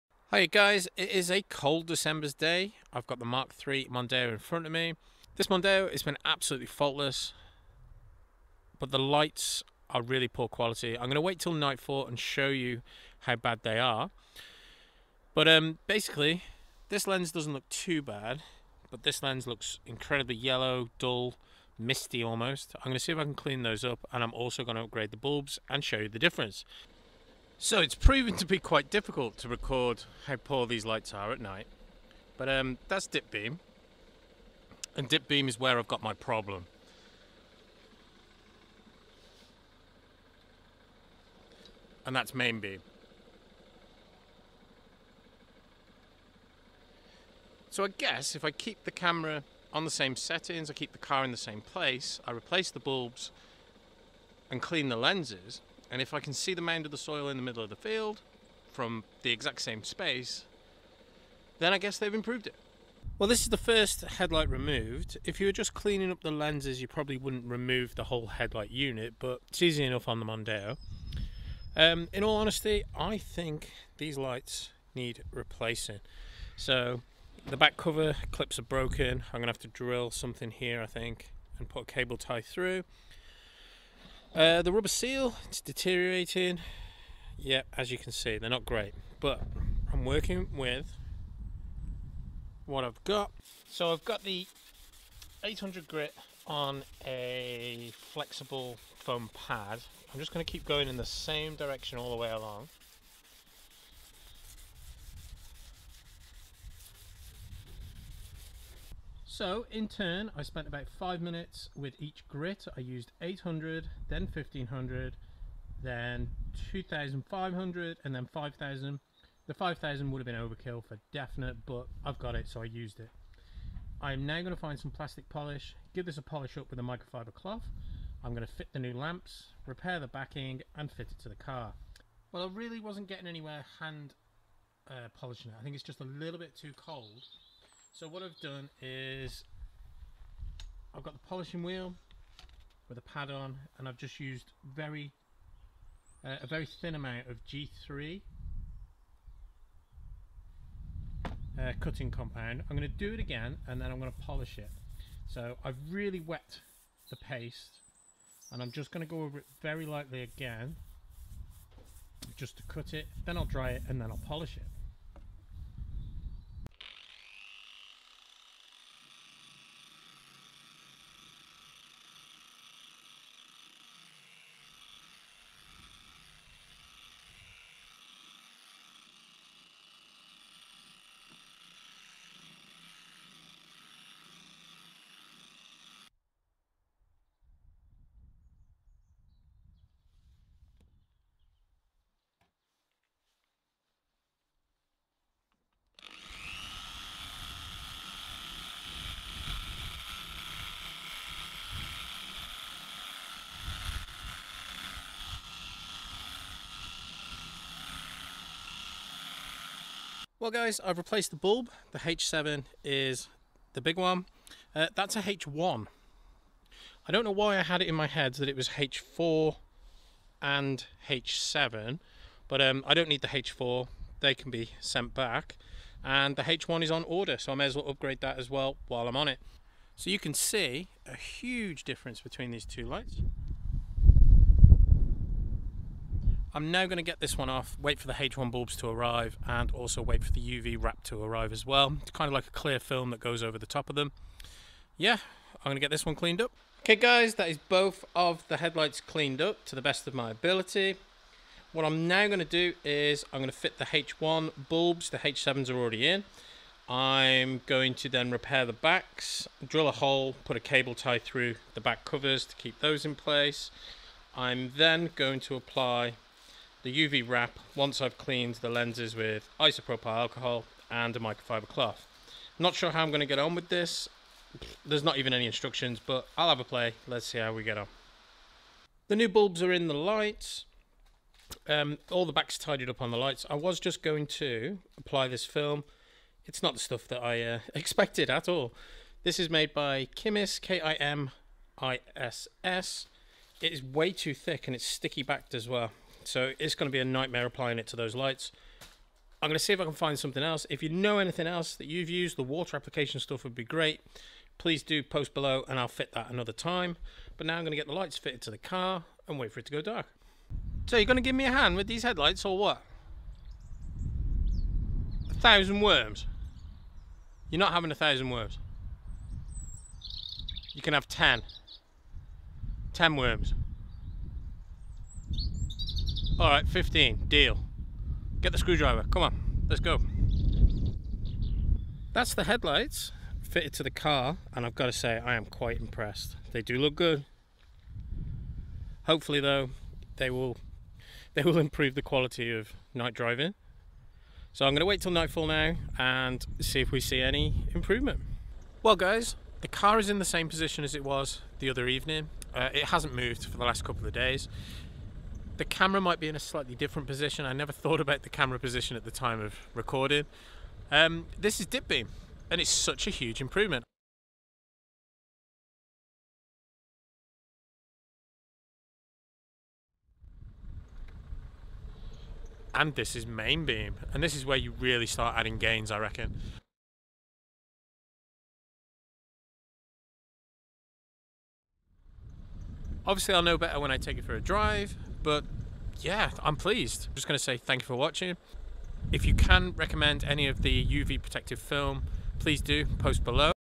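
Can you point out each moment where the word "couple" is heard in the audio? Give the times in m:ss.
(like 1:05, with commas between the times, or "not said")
5:53.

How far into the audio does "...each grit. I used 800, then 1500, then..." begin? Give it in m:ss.
1:52.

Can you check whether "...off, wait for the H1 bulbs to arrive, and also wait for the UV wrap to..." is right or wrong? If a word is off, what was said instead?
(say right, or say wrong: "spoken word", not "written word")
right.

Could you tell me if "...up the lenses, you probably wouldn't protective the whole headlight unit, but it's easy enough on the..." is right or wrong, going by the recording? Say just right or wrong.
wrong.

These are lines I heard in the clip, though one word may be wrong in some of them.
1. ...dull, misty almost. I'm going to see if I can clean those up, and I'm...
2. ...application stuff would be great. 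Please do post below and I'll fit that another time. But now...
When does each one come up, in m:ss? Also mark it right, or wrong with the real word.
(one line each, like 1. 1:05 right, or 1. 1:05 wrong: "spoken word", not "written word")
1. 0:20 right
2. 5:02 right.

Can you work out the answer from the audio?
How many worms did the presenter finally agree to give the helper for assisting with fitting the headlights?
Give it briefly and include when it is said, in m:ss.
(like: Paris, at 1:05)
15, at 5:26.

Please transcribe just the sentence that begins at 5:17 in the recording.
You're not having a thousand worms.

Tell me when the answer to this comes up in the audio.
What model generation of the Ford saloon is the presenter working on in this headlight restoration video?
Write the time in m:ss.
0:03.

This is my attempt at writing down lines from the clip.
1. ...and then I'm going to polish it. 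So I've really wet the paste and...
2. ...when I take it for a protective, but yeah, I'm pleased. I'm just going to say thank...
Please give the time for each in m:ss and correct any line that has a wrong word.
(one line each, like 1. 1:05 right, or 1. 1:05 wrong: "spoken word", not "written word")
1. 2:33 right
2. 6:23 wrong: "drive", not "protective".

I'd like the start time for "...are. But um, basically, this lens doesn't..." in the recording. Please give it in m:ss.
0:13.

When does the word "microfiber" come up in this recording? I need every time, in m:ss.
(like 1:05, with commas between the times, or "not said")
2:06, 4:31.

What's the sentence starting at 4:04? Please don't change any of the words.
Yeah, I'm going to get this one cleaned up.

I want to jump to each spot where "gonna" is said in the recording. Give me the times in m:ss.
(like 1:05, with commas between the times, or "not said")
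1:19, 5:44.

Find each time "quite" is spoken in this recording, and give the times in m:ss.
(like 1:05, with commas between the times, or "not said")
0:28, 5:35.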